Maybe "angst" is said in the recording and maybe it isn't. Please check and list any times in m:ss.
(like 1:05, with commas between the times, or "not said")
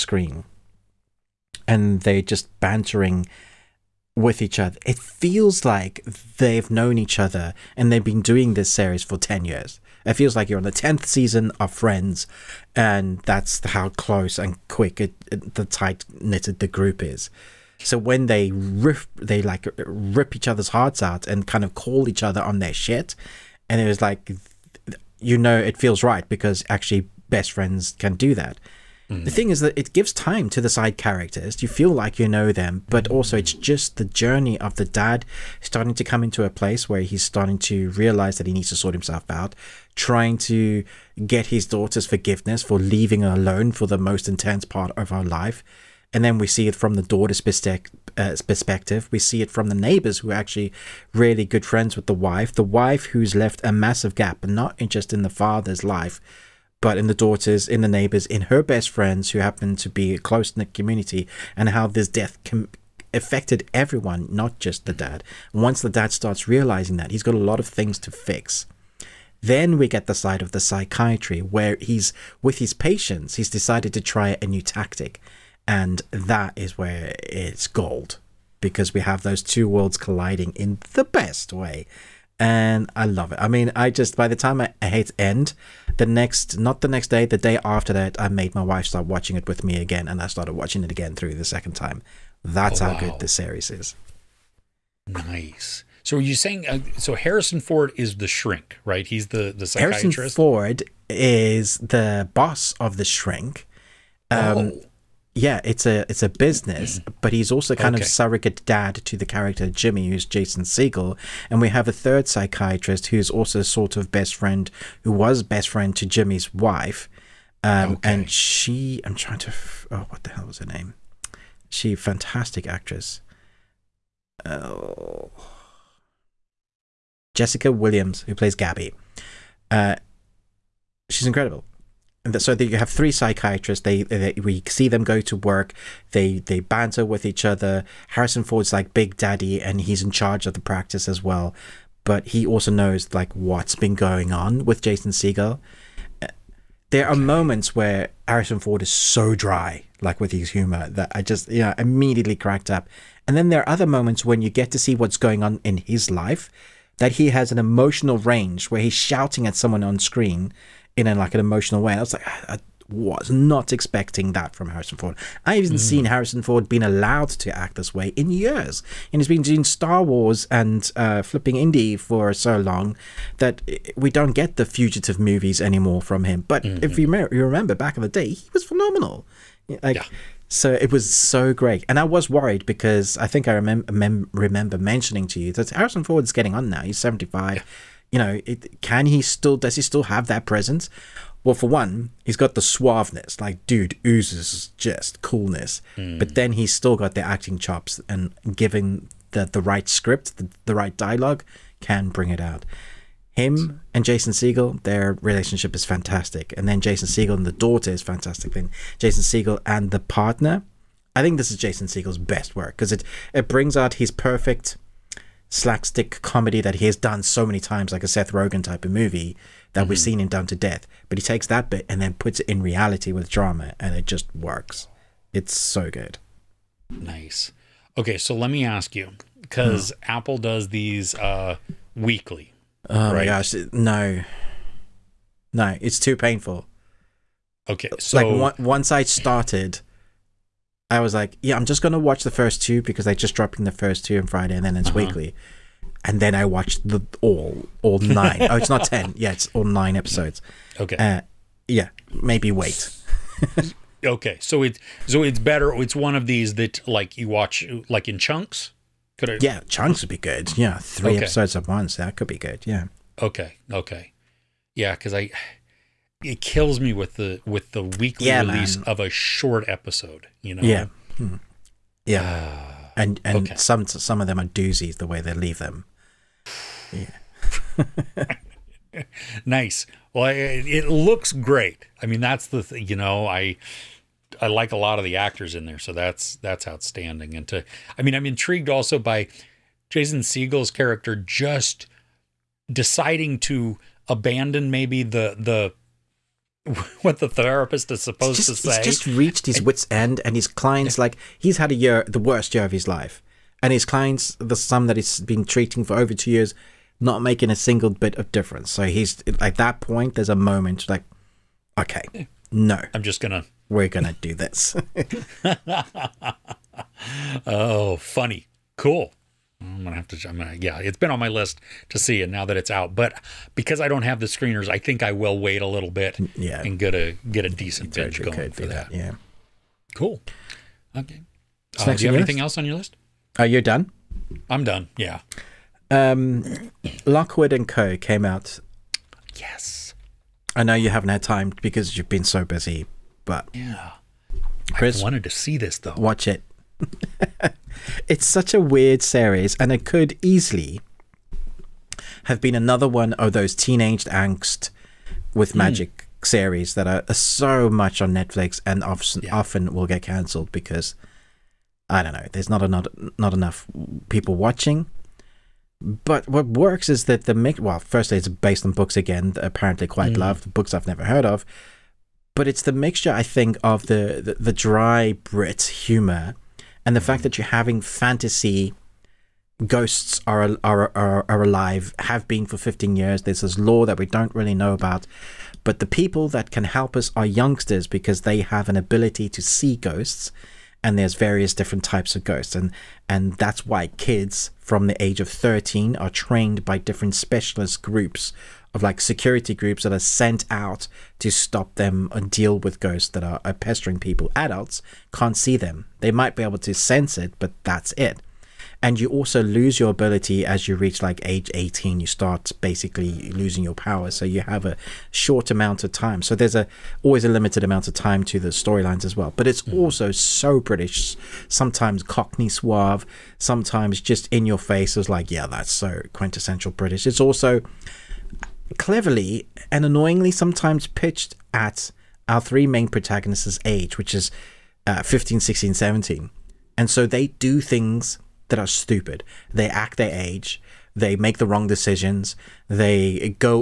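5:54.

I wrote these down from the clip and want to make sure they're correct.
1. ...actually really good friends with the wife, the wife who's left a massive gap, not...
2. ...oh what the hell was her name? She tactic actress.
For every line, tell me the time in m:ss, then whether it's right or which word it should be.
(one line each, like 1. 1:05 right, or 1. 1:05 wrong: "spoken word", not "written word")
1. 0:50 right
2. 1:59 wrong: "fantastic", not "tactic".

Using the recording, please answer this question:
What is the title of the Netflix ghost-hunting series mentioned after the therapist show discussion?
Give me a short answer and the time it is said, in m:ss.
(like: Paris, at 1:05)
Lockwood and Co., at 5:37.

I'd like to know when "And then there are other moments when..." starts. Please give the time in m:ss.
2:33.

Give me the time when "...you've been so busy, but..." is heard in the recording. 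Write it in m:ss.
5:41.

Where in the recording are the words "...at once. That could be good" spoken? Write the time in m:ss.
4:21.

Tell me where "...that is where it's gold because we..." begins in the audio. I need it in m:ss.
1:16.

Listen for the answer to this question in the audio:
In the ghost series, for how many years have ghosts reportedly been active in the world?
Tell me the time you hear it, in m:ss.
6:22.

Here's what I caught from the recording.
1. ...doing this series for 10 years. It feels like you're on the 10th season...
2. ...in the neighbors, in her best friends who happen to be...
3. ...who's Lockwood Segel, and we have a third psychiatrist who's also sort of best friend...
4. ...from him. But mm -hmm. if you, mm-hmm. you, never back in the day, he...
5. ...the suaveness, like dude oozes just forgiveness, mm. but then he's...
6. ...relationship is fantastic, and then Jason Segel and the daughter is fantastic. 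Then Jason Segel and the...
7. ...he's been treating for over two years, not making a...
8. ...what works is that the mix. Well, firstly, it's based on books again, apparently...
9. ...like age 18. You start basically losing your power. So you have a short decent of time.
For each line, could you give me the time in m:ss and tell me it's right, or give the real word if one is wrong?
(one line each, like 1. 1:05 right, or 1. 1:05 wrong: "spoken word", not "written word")
1. 0:08 right
2. 0:57 right
3. 1:50 wrong: "Jason", not "Lockwood"
4. 2:56 wrong: "remember", not "never"
5. 3:12 wrong: "coolness", not "forgiveness"
6. 3:25 right
7. 5:04 right
8. 6:06 right
9. 6:51 wrong: "amount", not "decent".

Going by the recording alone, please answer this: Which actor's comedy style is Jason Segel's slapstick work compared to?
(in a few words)
Seth Rogen.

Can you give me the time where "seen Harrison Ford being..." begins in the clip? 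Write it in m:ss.
2:45.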